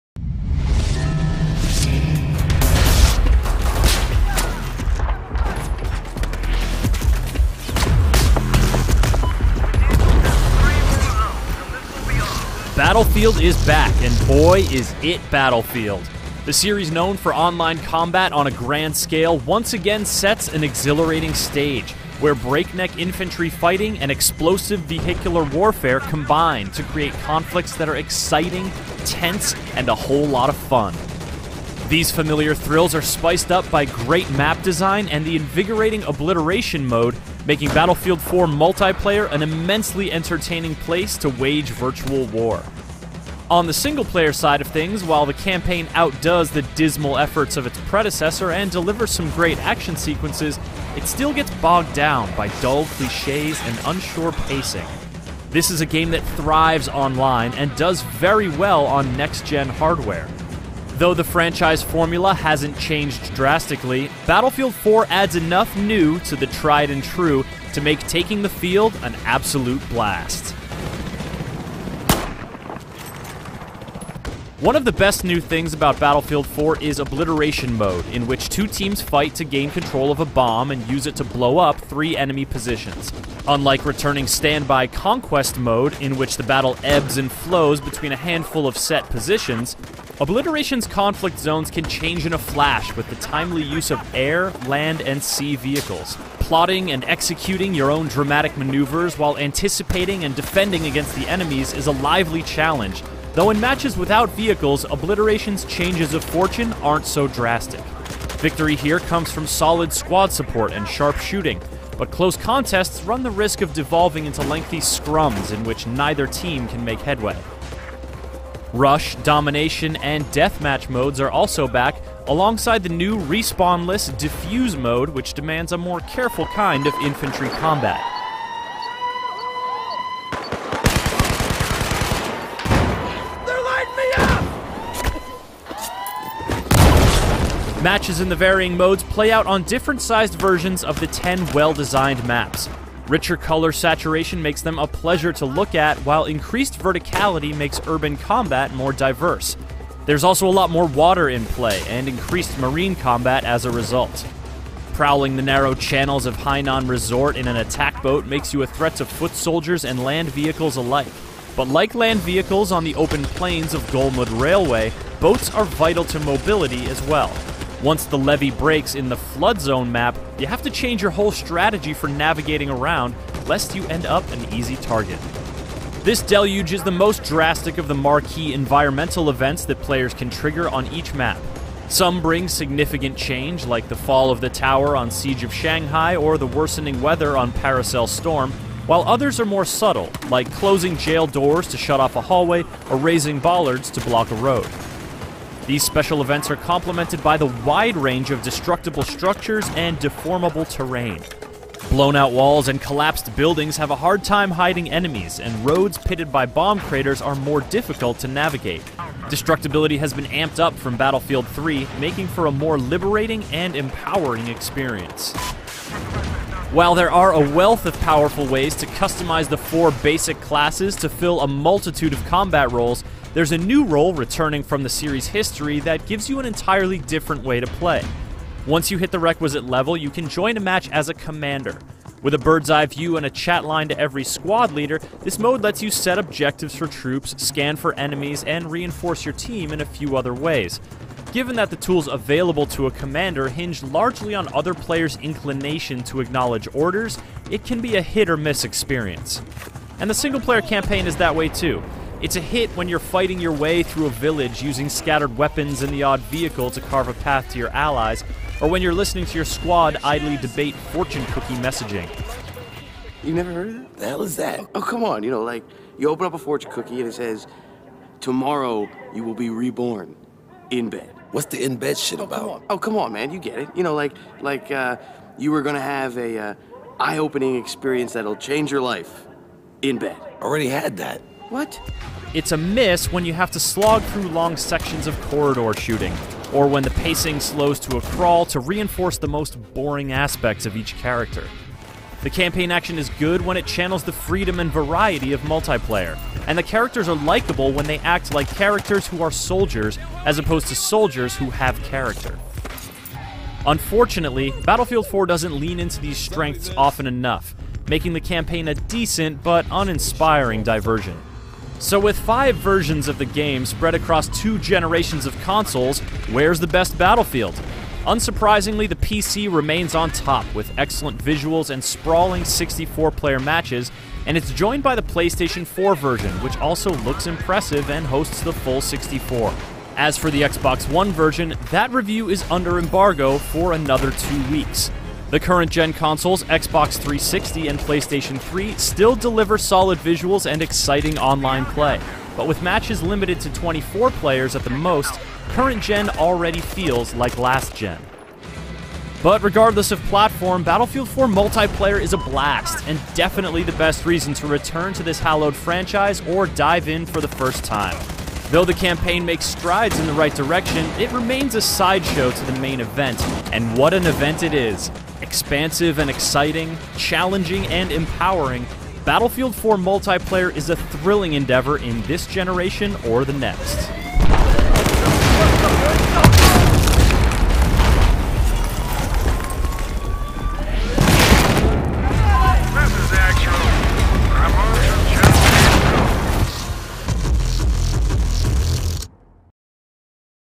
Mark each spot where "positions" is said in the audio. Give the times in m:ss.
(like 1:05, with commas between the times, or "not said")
1:22, 1:29.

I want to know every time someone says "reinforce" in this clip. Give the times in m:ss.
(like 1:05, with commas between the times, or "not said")
3:58, 4:48.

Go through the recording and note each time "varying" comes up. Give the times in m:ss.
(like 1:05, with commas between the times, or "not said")
2:18.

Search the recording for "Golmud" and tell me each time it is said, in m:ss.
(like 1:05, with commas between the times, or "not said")
2:43.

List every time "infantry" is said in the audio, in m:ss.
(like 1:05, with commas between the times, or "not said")
0:22, 2:07.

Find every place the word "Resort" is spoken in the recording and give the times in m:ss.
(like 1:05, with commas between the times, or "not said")
2:36.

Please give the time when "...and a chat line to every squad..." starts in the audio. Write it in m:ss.
3:53.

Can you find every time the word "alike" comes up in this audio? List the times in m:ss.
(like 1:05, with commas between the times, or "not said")
2:40.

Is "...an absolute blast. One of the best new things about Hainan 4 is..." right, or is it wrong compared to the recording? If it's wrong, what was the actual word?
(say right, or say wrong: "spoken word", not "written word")
wrong: "Battlefield", not "Hainan".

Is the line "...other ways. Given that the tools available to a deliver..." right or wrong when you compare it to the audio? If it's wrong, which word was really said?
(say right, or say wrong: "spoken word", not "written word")
wrong: "commander", not "deliver".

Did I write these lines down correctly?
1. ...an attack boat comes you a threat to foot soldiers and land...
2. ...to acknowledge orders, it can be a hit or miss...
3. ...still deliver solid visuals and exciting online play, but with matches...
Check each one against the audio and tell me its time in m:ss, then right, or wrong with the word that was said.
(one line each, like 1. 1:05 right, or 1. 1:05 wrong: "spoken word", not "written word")
1. 2:37 wrong: "makes", not "comes"
2. 4:06 right
3. 5:38 right.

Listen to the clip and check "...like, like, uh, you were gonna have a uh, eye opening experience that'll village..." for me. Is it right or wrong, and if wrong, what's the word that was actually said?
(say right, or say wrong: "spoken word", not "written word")
wrong: "change", not "village".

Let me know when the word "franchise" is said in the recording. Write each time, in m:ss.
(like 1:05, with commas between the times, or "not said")
1:01, 5:55.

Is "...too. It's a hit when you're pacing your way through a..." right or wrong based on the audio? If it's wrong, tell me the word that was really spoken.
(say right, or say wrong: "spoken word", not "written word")
wrong: "fighting", not "pacing".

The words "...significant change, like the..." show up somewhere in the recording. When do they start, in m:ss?
3:02.